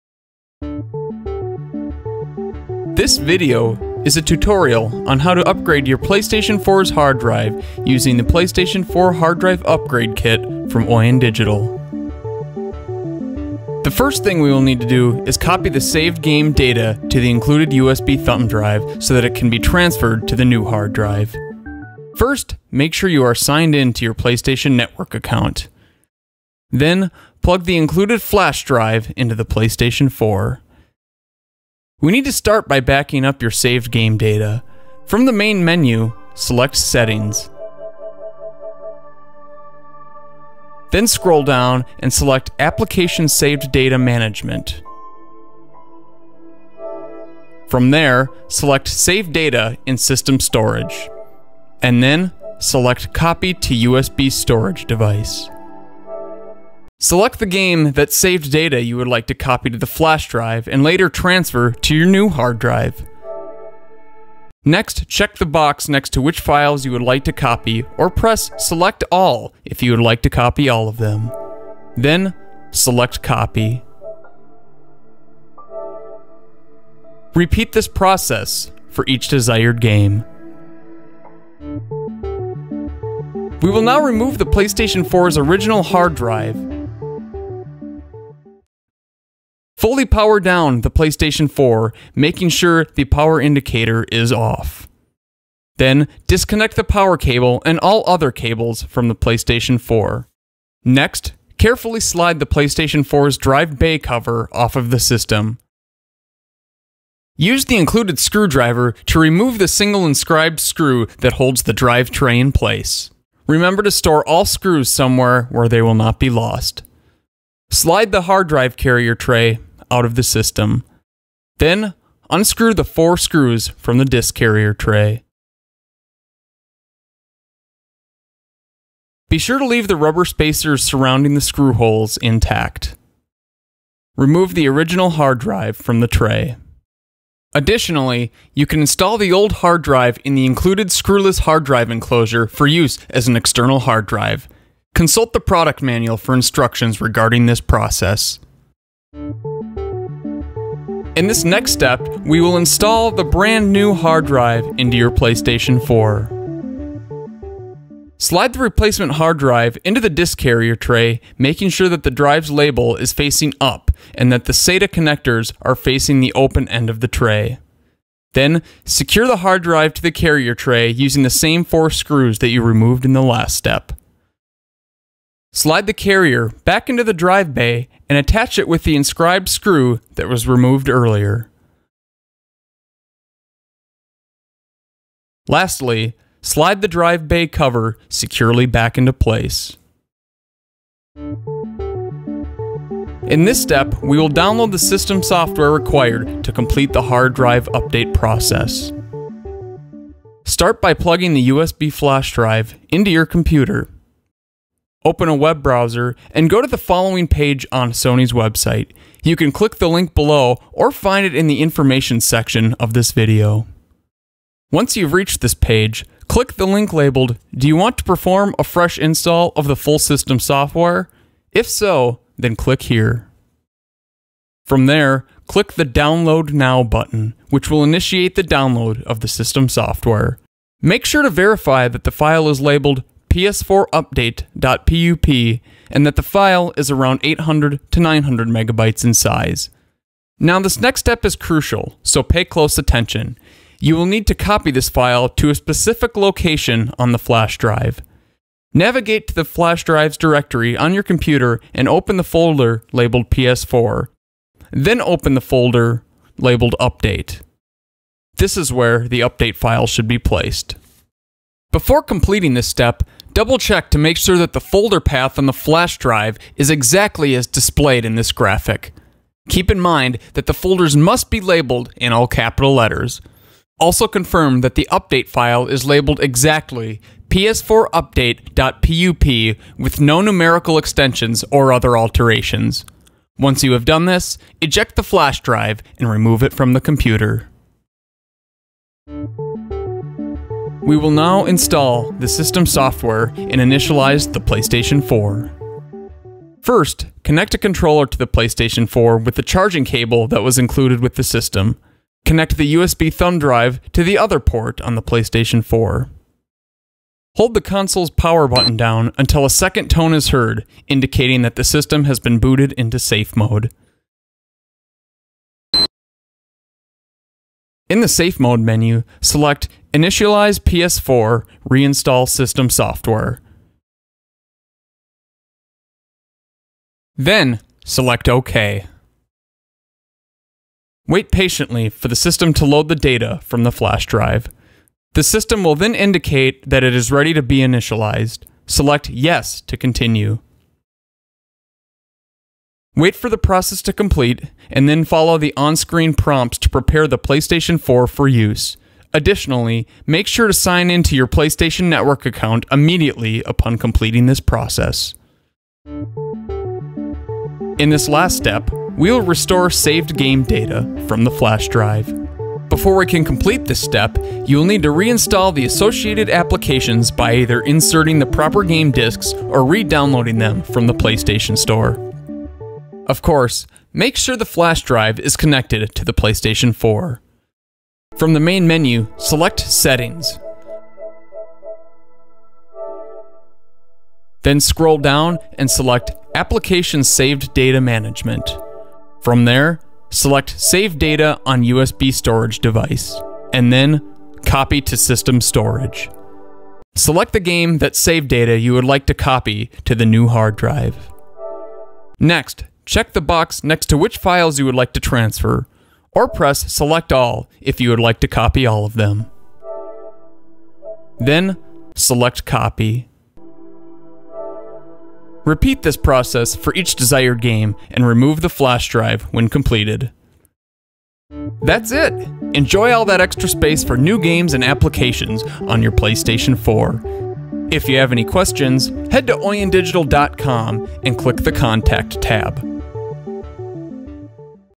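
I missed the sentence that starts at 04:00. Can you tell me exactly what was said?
Now this next step is crucial, so pay close attention.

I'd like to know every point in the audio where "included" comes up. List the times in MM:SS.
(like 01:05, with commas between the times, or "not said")
00:17, 00:27, 01:47, 02:20, 05:00.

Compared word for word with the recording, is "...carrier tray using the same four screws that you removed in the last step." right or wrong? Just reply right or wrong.
right.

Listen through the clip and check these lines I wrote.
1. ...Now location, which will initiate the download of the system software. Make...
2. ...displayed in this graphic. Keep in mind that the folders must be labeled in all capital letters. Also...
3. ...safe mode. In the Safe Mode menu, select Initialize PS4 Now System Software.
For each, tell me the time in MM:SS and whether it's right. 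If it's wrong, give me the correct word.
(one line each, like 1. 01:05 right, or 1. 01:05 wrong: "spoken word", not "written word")
1. 03:46 wrong: "button", not "location"
2. 04:27 right
3. 05:12 wrong: "Reinstall", not "Now".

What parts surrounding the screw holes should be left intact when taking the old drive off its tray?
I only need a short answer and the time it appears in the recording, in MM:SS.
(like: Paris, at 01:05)
rubber spacers, at 02:09.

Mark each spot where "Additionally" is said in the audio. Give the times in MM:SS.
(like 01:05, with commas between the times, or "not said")
02:17, 05:49.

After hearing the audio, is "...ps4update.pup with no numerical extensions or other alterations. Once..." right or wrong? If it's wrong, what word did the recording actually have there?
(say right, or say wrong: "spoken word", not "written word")
right.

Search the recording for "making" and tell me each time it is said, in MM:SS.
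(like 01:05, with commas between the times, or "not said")
01:32, 02:41.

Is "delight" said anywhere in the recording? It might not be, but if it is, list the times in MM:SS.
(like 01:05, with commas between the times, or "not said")
not said.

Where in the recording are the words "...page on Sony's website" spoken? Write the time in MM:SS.
03:27.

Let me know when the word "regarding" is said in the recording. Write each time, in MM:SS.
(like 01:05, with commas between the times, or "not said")
02:27.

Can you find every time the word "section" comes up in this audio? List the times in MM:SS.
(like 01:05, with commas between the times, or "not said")
03:32.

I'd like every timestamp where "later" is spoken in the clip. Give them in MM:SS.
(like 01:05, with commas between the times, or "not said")
01:00.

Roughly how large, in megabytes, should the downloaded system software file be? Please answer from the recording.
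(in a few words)
800 to 900 megabytes.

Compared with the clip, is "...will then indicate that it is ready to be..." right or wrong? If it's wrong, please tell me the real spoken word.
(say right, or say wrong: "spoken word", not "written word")
right.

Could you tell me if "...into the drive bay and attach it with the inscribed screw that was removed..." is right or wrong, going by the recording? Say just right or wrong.
right.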